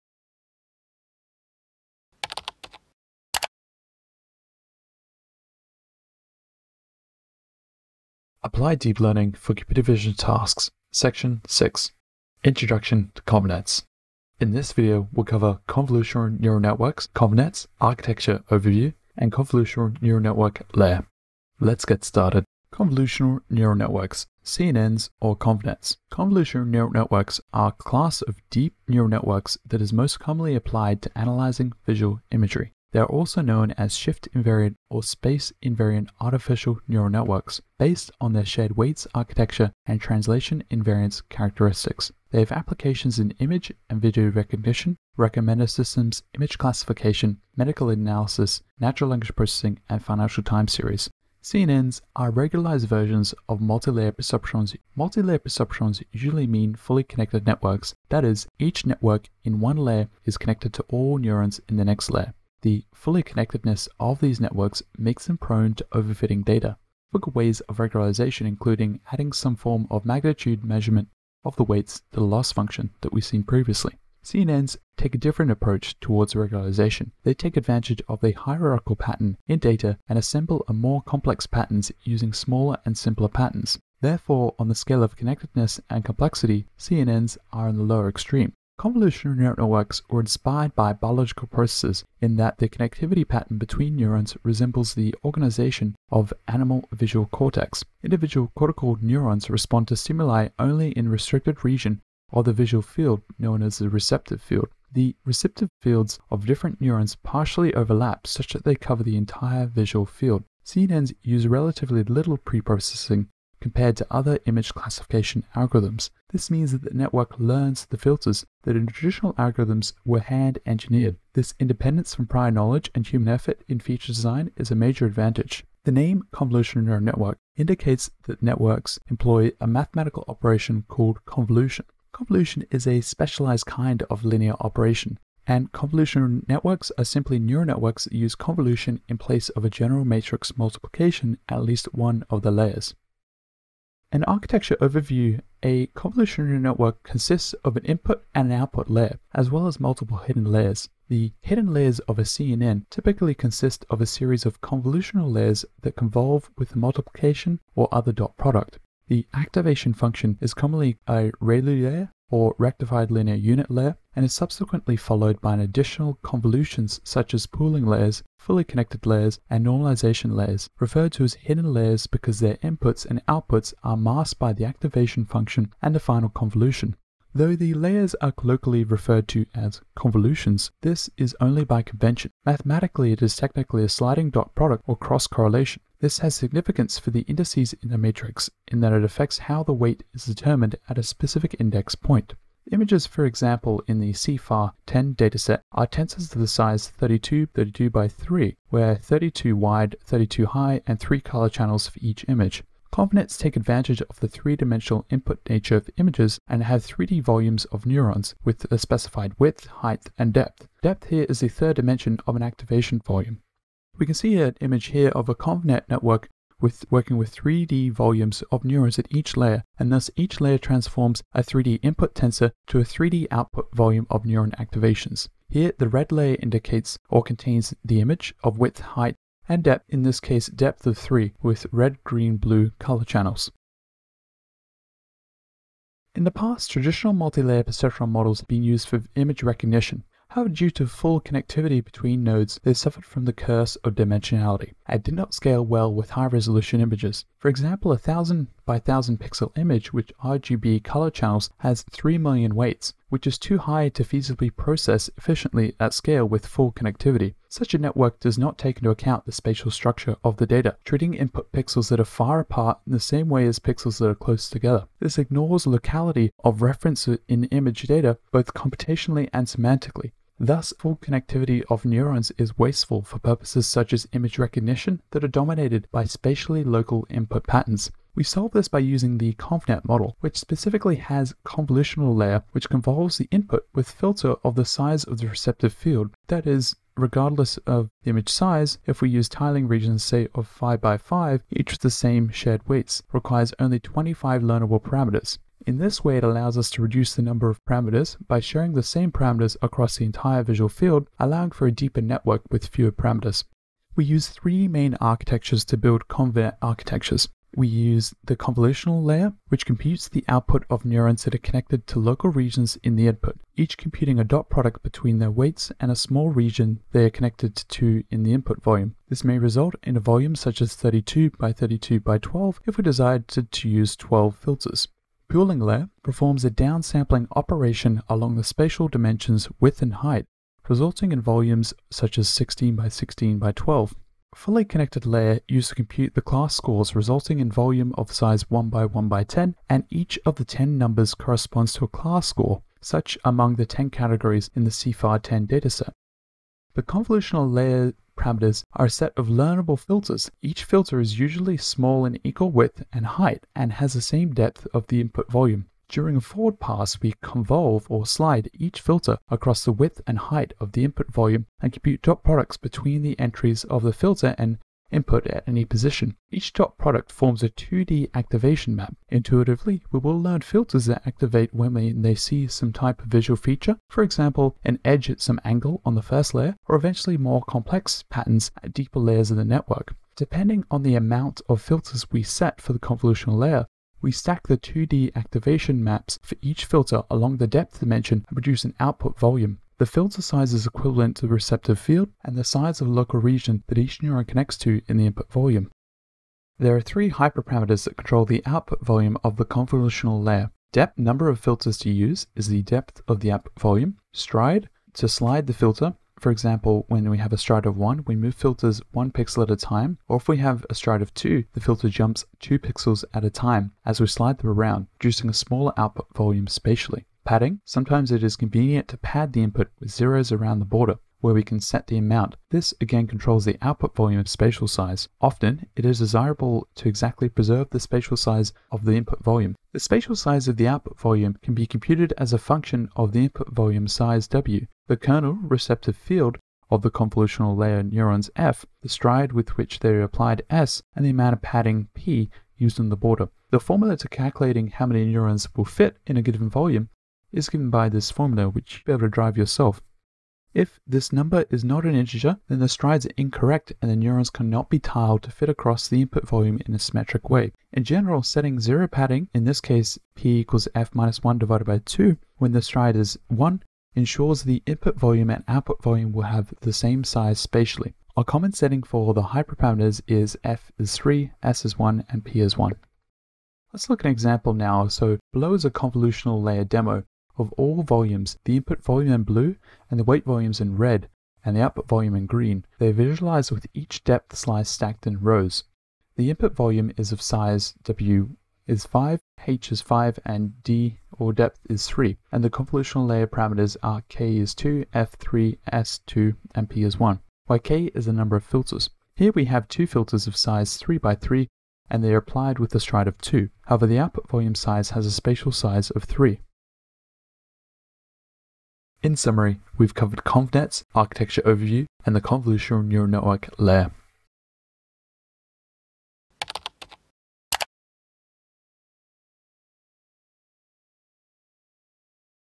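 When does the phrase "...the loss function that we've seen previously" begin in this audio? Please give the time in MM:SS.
01:12.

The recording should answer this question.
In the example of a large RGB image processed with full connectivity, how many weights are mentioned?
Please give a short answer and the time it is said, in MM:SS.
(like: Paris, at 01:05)
3 million, at 04:11.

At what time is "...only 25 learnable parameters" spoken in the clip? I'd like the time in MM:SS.
04:53.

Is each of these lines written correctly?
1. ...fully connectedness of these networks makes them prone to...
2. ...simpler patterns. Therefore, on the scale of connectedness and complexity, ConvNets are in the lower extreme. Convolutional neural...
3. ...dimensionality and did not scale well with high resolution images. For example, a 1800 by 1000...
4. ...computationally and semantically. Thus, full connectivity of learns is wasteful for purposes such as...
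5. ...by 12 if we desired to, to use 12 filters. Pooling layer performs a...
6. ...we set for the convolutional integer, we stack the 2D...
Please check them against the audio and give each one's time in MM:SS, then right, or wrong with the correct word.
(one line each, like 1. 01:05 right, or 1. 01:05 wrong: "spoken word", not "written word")
1. 01:02 right
2. 01:22 wrong: "CNNs", not "ConvNets"
3. 04:03 wrong: "1000", not "1800"
4. 04:28 wrong: "neurons", not "learns"
5. 05:21 right
6. 06:22 wrong: "layer", not "integer".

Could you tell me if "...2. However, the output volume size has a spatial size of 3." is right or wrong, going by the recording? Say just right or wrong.
right.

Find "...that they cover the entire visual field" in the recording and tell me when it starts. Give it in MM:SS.
01:48.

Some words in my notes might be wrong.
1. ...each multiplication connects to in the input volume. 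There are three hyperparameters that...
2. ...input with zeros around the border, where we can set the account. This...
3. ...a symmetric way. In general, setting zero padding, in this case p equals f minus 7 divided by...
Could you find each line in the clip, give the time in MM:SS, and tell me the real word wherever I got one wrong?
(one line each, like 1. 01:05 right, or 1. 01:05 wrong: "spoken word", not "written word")
1. 06:33 wrong: "neuron", not "multiplication"
2. 06:59 wrong: "amount", not "account"
3. 07:36 wrong: "1", not "7".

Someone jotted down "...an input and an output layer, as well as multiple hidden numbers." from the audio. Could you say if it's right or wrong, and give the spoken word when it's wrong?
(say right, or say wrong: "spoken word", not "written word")
wrong: "layers", not "numbers".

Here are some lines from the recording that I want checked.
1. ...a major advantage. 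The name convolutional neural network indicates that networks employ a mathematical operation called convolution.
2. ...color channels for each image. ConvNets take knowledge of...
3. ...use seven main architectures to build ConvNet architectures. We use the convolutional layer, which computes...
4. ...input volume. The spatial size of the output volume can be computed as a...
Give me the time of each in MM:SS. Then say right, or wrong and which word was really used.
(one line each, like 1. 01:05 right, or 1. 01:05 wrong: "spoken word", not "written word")
1. 02:04 right
2. 03:21 wrong: "advantage", not "knowledge"
3. 05:04 wrong: "three", not "seven"
4. 07:08 right.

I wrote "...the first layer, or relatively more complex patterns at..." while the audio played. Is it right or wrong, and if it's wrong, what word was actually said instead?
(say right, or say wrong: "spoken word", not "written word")
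wrong: "eventually", not "relatively".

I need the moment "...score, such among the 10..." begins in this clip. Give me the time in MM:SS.
05:42.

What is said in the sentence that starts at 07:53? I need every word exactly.
Let's look at an example now.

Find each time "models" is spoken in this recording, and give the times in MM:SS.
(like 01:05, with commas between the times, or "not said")
03:58, 04:39.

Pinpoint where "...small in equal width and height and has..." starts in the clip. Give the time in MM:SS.
05:51.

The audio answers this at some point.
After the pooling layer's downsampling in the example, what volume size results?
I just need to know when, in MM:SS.
05:32.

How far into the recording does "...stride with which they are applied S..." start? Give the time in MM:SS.
07:18.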